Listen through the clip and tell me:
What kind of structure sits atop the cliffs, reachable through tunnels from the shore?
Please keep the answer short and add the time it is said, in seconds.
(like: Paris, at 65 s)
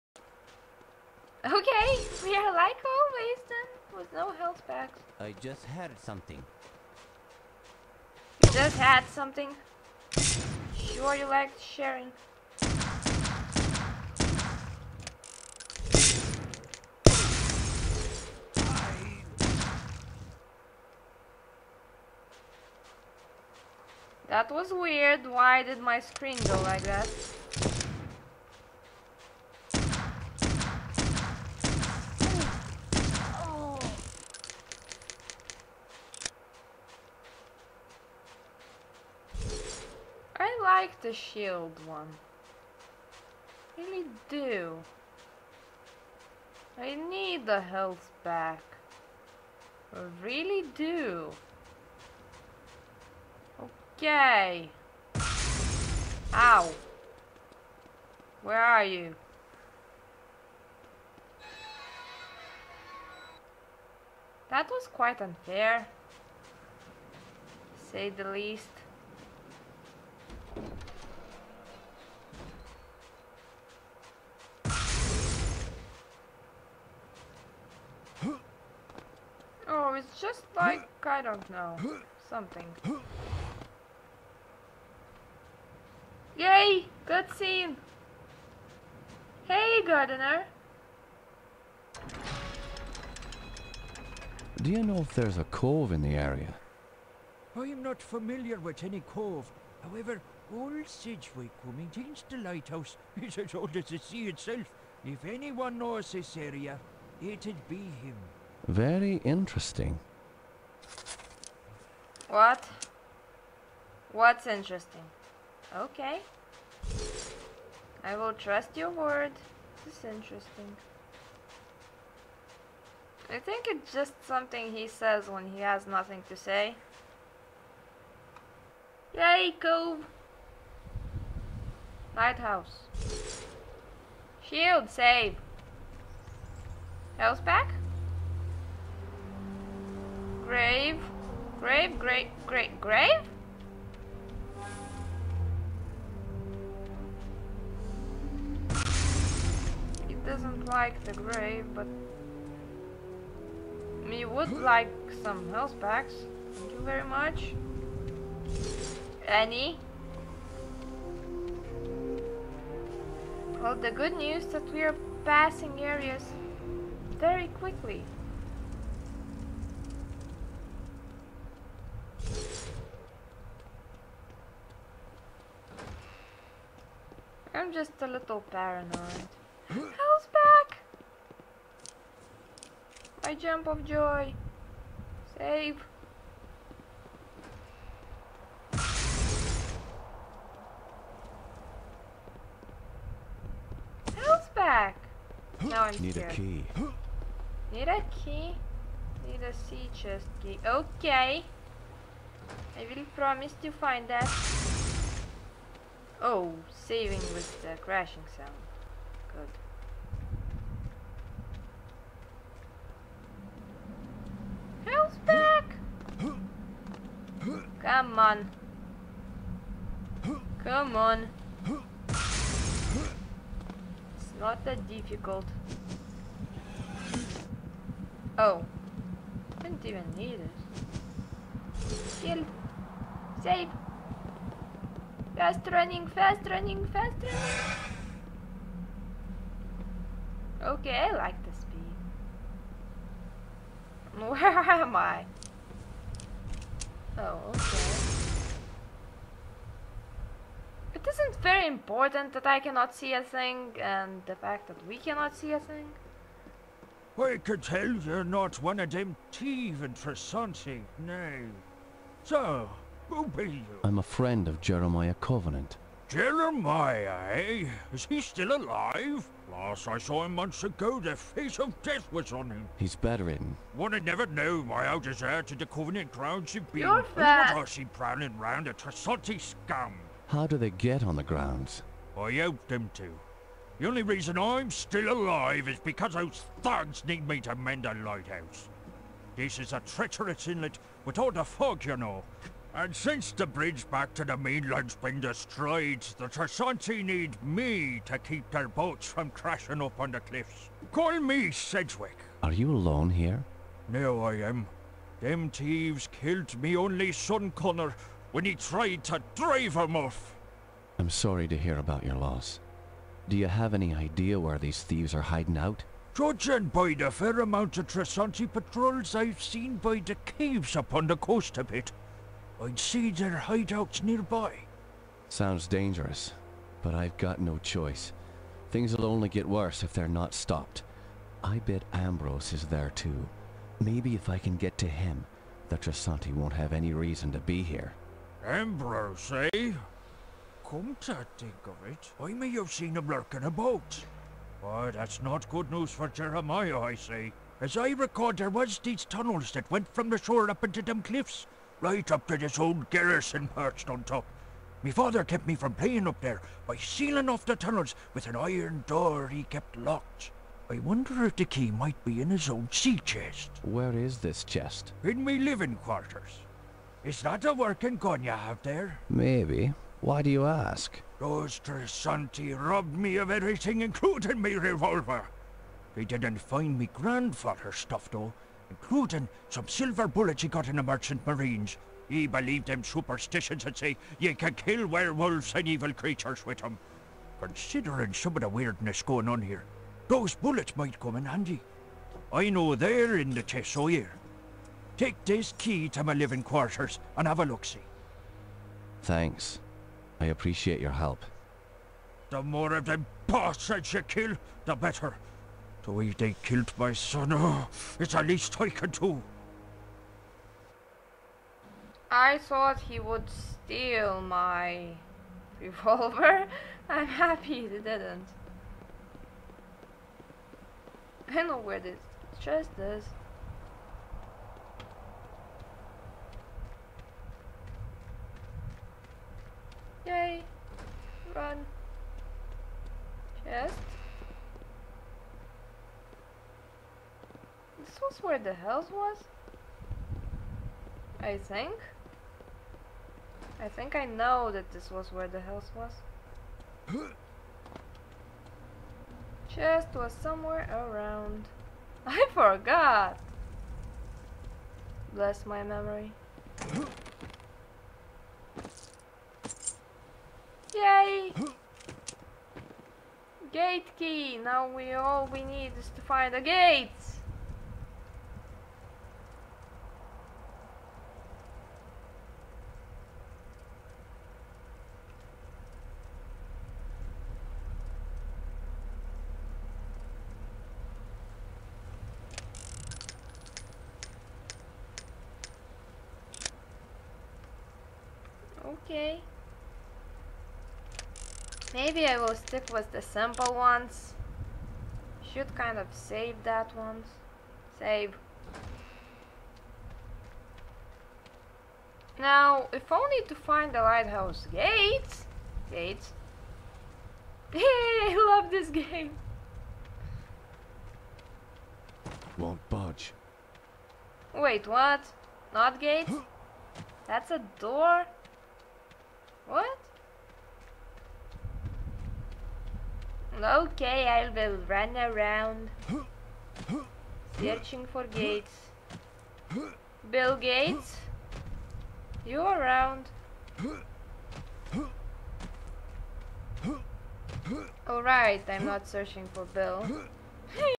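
old garrison, at 352 s.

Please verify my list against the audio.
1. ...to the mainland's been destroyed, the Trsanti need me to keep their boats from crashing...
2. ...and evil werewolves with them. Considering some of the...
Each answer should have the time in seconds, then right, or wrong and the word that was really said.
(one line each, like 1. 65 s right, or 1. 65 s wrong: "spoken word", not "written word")
1. 294 s right
2. 385 s wrong: "creatures", not "werewolves".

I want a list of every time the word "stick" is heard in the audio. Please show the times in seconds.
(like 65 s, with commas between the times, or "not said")
492 s.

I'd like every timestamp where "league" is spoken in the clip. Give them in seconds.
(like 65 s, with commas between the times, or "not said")
not said.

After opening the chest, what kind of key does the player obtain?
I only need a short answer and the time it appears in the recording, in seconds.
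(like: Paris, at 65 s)
Gate key, at 463 s.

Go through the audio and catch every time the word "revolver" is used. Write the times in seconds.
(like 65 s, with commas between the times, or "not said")
374 s, 415 s.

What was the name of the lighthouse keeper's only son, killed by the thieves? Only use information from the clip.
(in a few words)
Connor.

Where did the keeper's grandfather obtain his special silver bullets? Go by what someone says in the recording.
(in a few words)
Merchant Marines.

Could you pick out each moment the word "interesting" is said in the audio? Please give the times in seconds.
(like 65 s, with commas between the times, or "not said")
109 s, 114 s, 120 s.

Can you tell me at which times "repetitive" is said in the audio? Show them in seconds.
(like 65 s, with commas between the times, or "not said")
not said.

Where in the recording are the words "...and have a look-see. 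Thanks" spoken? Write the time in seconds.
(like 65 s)
397 s.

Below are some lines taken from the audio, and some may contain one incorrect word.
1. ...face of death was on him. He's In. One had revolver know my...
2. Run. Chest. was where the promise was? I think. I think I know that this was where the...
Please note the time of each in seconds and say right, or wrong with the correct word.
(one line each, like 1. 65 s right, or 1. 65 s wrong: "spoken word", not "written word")
1. 271 s wrong: "never", not "revolver"
2. 431 s wrong: "house", not "promise".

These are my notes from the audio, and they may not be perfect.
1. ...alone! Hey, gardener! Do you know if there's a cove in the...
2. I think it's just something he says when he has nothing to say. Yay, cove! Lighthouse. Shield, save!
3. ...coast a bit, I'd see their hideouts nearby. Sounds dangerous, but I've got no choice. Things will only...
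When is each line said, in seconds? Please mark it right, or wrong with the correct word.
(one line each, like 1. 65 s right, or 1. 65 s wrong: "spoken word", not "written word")
1. 87 s wrong: "scene", not "alone"
2. 123 s right
3. 321 s right.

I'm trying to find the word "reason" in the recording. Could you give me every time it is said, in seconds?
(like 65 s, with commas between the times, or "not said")
284 s, 336 s.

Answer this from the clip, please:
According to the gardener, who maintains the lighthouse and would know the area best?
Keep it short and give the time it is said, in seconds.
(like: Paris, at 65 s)
Sidgwick, at 100 s.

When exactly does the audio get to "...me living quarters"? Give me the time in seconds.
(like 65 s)
365 s.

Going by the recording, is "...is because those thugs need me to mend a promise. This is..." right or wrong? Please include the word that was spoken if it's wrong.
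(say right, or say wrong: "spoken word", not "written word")
wrong: "lighthouse", not "promise".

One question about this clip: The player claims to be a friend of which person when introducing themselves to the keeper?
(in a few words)
Jeremiah Covenant.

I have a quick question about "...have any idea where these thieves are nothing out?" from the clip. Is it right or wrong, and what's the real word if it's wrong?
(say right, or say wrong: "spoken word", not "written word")
wrong: "hiding", not "nothing".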